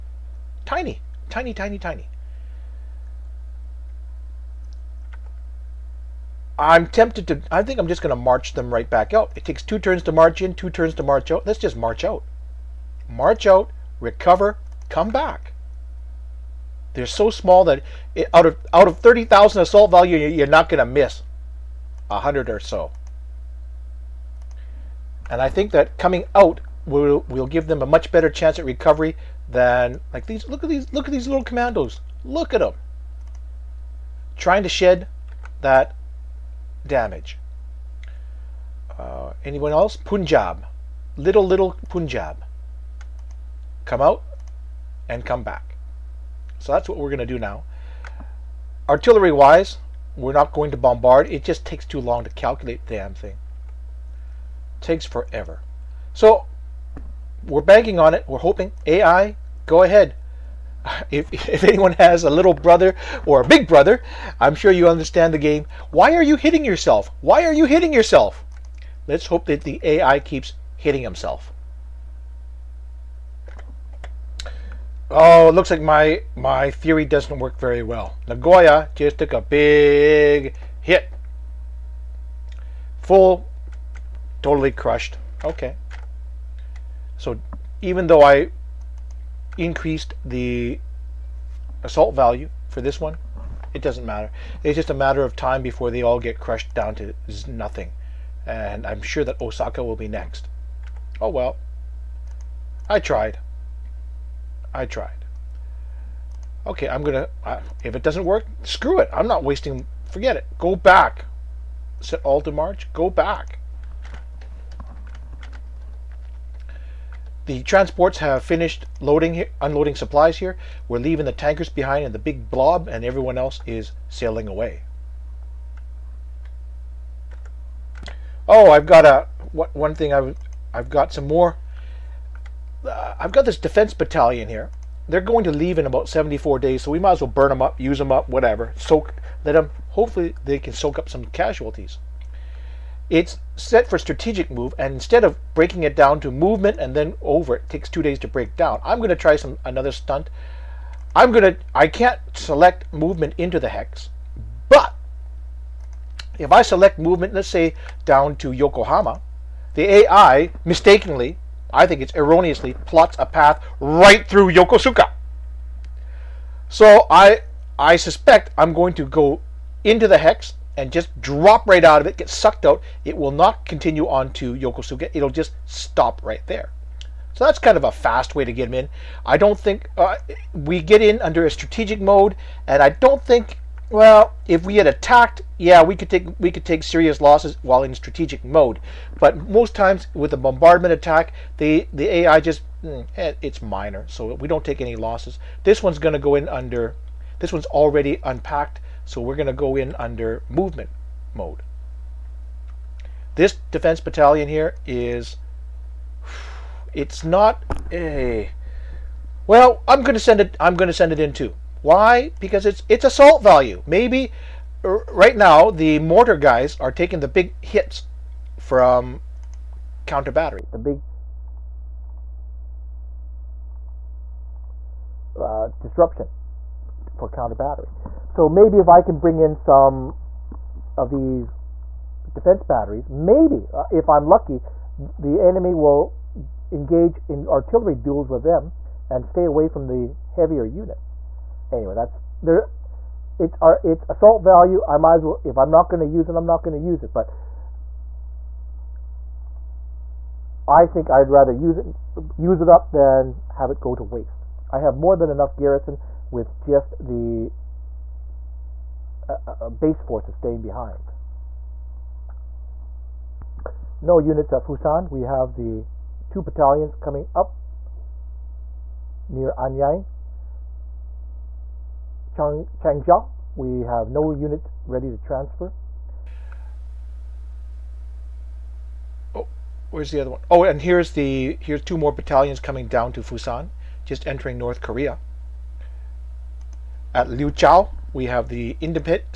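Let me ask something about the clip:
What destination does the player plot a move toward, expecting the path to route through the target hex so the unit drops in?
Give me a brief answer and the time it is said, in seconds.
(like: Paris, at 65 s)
Yokohama, at 158 s.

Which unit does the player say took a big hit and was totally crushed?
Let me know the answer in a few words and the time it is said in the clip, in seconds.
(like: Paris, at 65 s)
Nagoya, at 78 s.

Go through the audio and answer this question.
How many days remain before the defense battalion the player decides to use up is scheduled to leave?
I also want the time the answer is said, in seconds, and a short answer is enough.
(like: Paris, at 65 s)
74, at 136 s.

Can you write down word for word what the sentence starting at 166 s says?
So I I suspect I'm going to go into the hex and just drop right out of it, get sucked out.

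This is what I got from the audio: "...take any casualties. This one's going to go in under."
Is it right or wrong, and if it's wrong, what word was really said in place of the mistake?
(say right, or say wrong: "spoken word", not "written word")
wrong: "losses", not "casualties".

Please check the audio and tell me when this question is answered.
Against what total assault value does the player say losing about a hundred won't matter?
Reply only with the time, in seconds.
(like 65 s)
18 s.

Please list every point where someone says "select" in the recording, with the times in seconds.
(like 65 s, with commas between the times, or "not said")
152 s, 156 s.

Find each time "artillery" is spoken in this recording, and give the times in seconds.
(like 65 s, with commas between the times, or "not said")
48 s, 237 s.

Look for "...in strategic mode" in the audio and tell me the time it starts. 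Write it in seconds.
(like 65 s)
187 s.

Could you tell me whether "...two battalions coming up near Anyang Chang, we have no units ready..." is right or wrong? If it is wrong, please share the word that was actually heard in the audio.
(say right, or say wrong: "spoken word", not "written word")
right.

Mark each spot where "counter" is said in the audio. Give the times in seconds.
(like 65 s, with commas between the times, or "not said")
220 s, 227 s.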